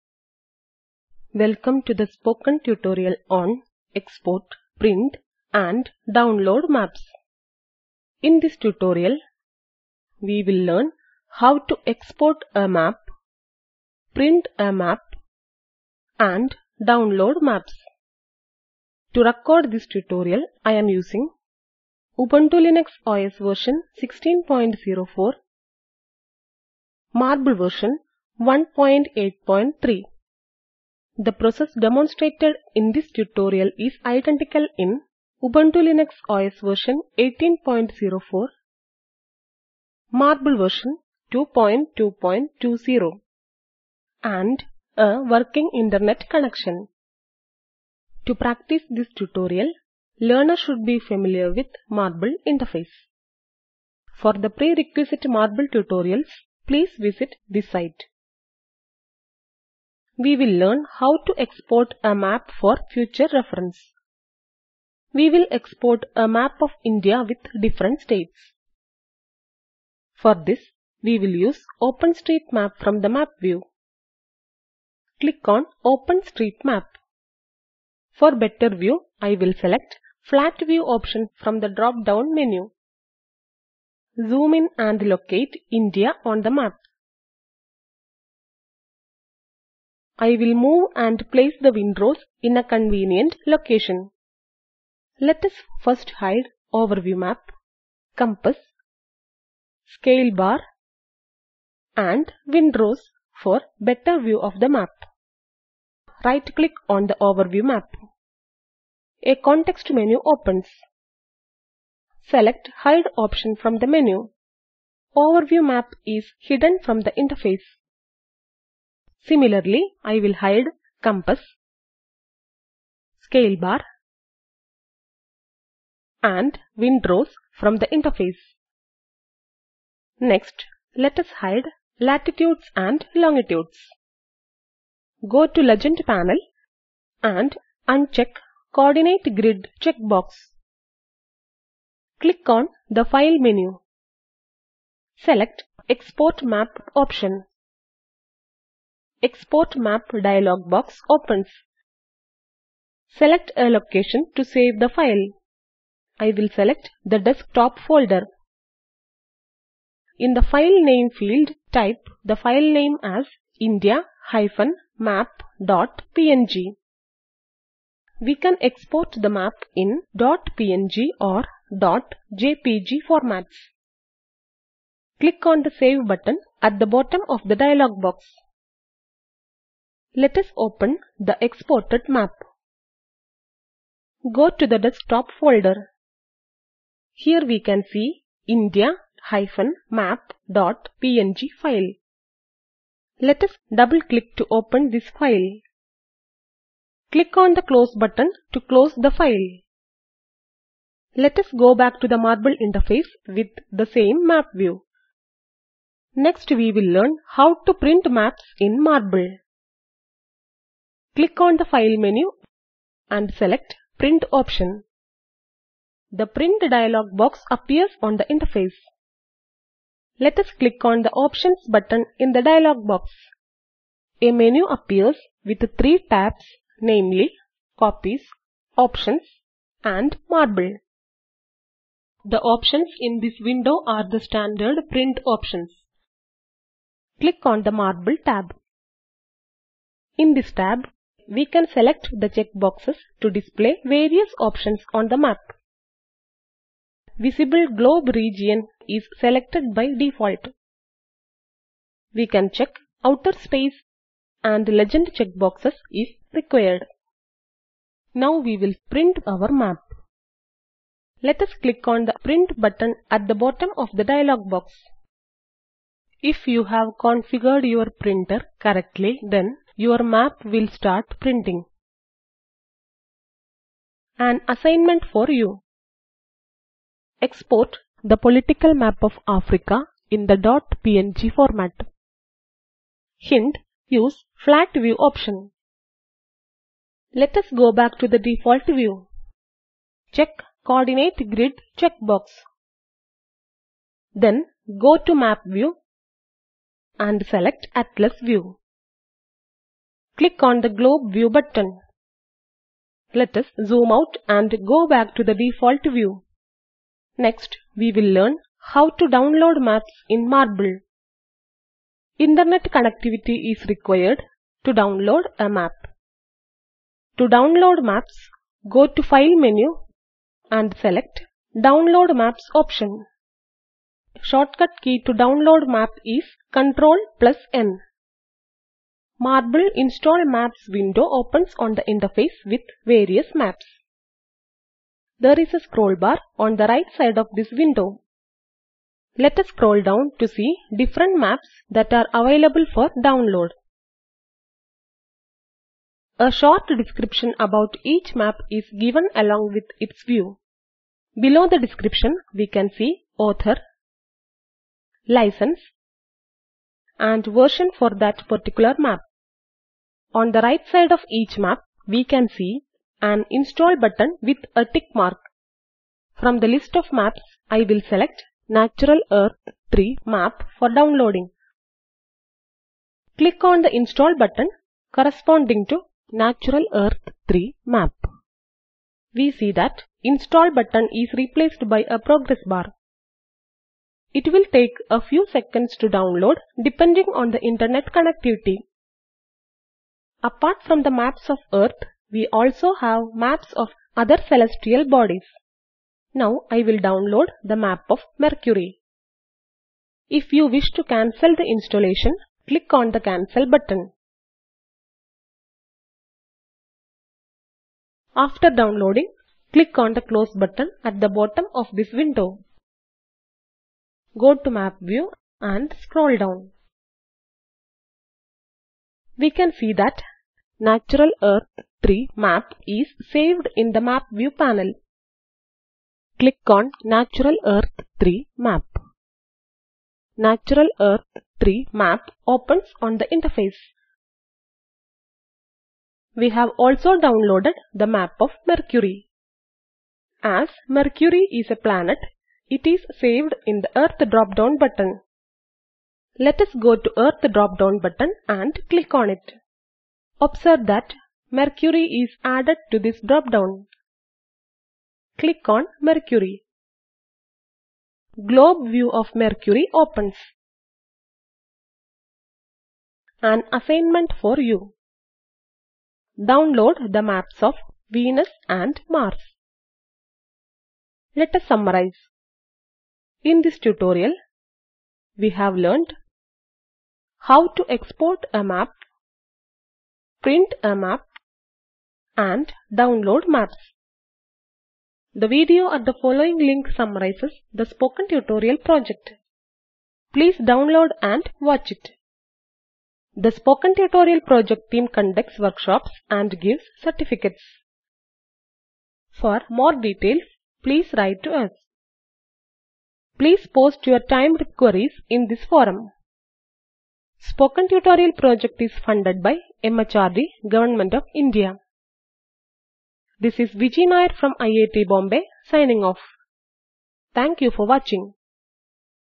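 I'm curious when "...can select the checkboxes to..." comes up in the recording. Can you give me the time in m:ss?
4:01.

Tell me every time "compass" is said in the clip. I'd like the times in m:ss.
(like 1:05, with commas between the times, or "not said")
1:38, 2:01.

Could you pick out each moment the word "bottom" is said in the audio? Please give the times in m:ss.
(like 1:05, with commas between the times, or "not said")
2:56, 4:23, 6:51.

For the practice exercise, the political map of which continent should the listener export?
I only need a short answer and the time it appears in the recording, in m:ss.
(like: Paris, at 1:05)
Africa, at 4:39.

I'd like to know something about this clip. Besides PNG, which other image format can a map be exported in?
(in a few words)
.jpg.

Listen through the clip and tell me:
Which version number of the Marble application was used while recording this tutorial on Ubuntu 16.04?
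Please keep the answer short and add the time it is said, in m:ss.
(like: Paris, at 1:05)
1.8.3, at 0:27.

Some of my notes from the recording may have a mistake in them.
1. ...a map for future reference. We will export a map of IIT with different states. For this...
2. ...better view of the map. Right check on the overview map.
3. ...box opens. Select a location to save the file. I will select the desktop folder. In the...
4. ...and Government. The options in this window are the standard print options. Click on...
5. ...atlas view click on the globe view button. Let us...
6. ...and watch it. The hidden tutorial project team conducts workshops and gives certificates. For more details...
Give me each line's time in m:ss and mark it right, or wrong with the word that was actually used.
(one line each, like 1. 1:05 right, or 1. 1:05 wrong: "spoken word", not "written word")
1. 1:02 wrong: "India", not "IIT"
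2. 1:43 wrong: "click", not "check"
3. 2:30 right
4. 3:49 wrong: "Marble", not "Government"
5. 4:57 right
6. 8:11 wrong: "spoken", not "hidden".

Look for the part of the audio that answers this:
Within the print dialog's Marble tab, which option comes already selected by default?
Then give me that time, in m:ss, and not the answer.
4:07.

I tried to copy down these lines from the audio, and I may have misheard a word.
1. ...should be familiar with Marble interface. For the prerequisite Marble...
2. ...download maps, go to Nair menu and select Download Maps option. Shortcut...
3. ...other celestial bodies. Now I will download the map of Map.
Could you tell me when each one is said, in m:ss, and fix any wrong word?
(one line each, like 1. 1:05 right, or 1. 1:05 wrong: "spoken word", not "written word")
1. 0:50 right
2. 5:17 wrong: "File", not "Nair"
3. 6:33 wrong: "Mercury", not "Map".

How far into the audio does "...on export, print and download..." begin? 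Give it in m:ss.
0:03.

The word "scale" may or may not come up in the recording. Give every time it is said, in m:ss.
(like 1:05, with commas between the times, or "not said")
1:39, 2:03.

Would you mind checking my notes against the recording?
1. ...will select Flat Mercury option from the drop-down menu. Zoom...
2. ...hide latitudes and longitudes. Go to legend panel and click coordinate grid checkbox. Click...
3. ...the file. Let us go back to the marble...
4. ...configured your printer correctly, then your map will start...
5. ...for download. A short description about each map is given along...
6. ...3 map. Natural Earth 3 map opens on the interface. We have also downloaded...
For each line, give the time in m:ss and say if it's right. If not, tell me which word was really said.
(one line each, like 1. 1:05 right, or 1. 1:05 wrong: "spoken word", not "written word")
1. 1:19 wrong: "View", not "Mercury"
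2. 2:11 wrong: "uncheck", not "click"
3. 3:18 right
4. 4:26 right
5. 5:42 right
6. 7:08 right.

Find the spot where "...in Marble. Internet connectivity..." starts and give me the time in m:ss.
5:10.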